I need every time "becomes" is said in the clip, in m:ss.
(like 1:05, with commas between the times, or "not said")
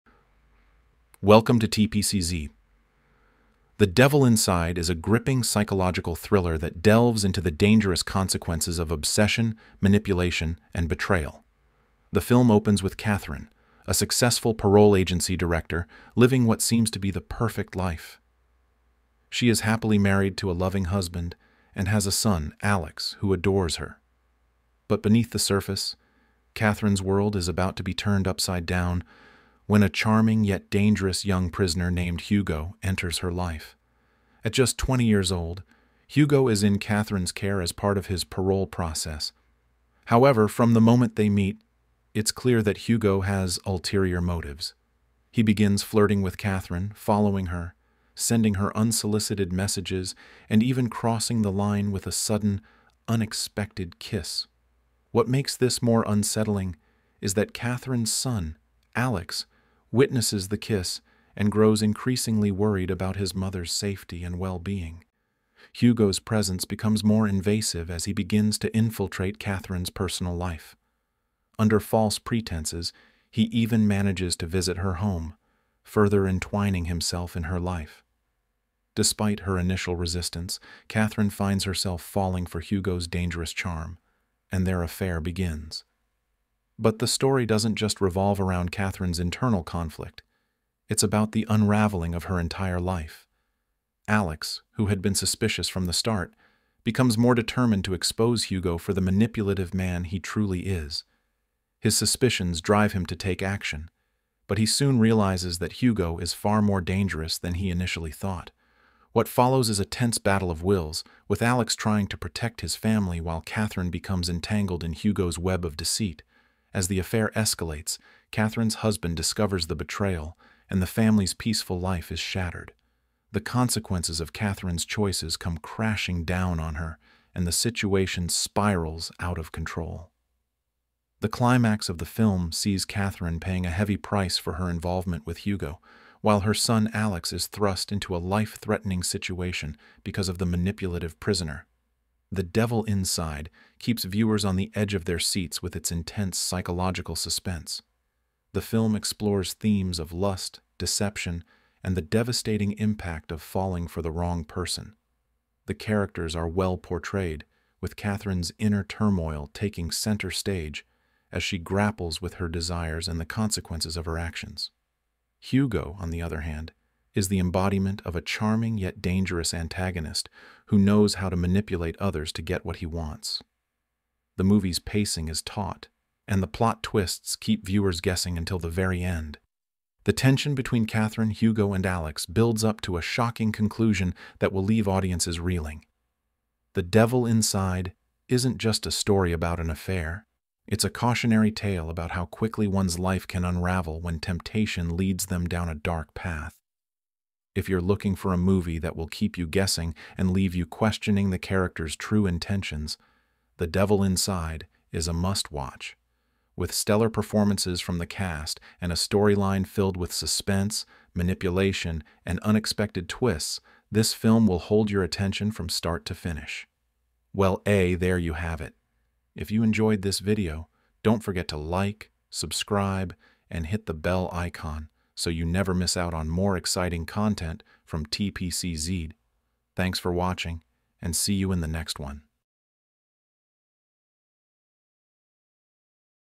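1:06, 1:36, 1:53.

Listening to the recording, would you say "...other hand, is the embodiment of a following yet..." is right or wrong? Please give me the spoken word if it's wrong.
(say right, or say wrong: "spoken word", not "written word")
wrong: "charming", not "following".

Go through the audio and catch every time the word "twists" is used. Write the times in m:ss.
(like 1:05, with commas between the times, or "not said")
2:56, 3:33.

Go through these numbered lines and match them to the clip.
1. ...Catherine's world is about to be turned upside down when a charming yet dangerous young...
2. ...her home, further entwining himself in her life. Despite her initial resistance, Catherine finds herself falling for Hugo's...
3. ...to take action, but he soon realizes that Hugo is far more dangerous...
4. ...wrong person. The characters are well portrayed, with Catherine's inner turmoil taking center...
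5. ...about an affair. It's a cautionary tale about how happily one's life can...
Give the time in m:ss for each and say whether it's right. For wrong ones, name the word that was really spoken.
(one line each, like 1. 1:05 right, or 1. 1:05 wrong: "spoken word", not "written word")
1. 0:26 right
2. 1:14 right
3. 1:43 right
4. 2:34 right
5. 3:09 wrong: "quickly", not "happily".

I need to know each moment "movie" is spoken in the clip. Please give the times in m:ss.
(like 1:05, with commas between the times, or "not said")
2:54, 3:18.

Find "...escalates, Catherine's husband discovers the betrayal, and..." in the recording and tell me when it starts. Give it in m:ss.
1:57.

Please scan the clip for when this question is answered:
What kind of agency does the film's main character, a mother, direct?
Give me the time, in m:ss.
0:14.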